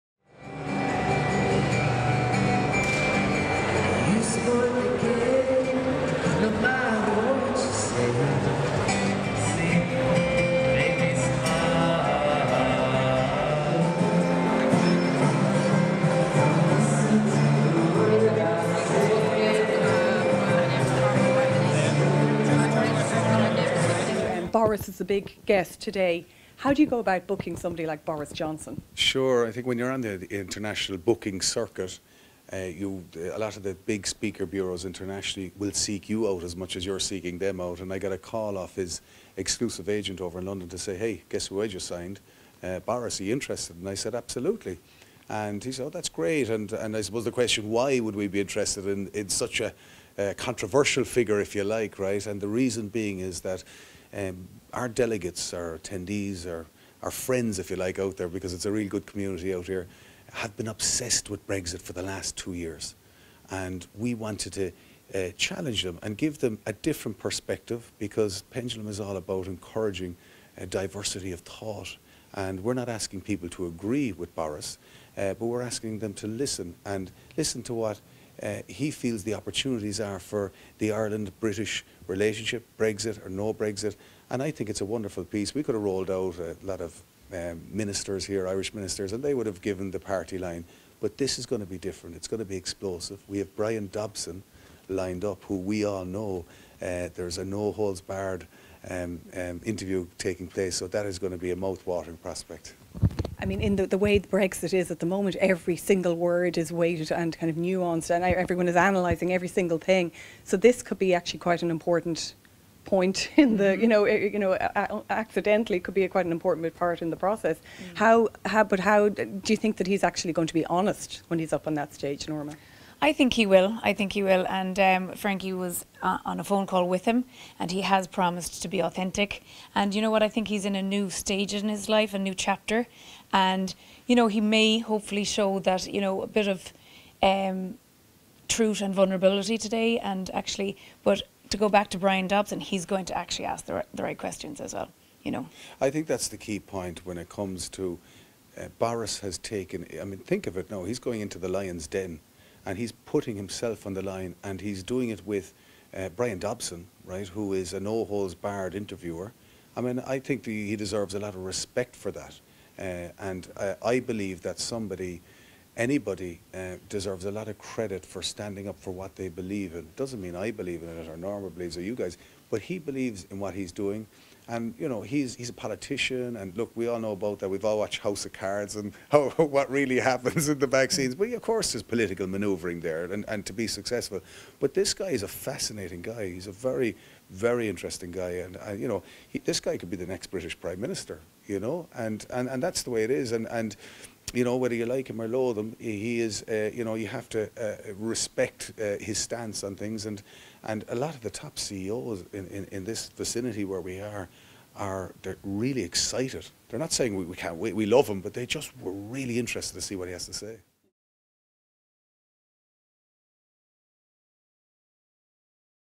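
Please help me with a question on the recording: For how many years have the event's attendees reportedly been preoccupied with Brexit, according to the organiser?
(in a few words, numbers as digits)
2.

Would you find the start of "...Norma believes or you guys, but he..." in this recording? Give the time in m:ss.
2:51.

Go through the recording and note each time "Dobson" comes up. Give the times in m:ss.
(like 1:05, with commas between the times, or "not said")
1:33, 2:22, 2:36.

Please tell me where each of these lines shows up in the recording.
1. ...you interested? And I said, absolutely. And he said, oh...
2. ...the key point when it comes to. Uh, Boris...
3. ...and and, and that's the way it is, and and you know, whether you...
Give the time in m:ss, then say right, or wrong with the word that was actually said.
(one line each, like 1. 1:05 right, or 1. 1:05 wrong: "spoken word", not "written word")
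1. 0:43 right
2. 2:26 right
3. 3:11 right.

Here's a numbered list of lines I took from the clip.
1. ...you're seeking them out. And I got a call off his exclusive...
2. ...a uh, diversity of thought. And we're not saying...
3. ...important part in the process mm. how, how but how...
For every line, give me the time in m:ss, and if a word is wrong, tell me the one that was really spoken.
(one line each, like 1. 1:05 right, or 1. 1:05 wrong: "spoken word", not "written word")
1. 0:36 right
2. 1:10 wrong: "asking", not "saying"
3. 1:56 right.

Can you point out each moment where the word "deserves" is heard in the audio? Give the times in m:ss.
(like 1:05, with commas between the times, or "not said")
2:40, 2:46.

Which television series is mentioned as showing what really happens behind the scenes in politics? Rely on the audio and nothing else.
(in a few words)
House of Cards.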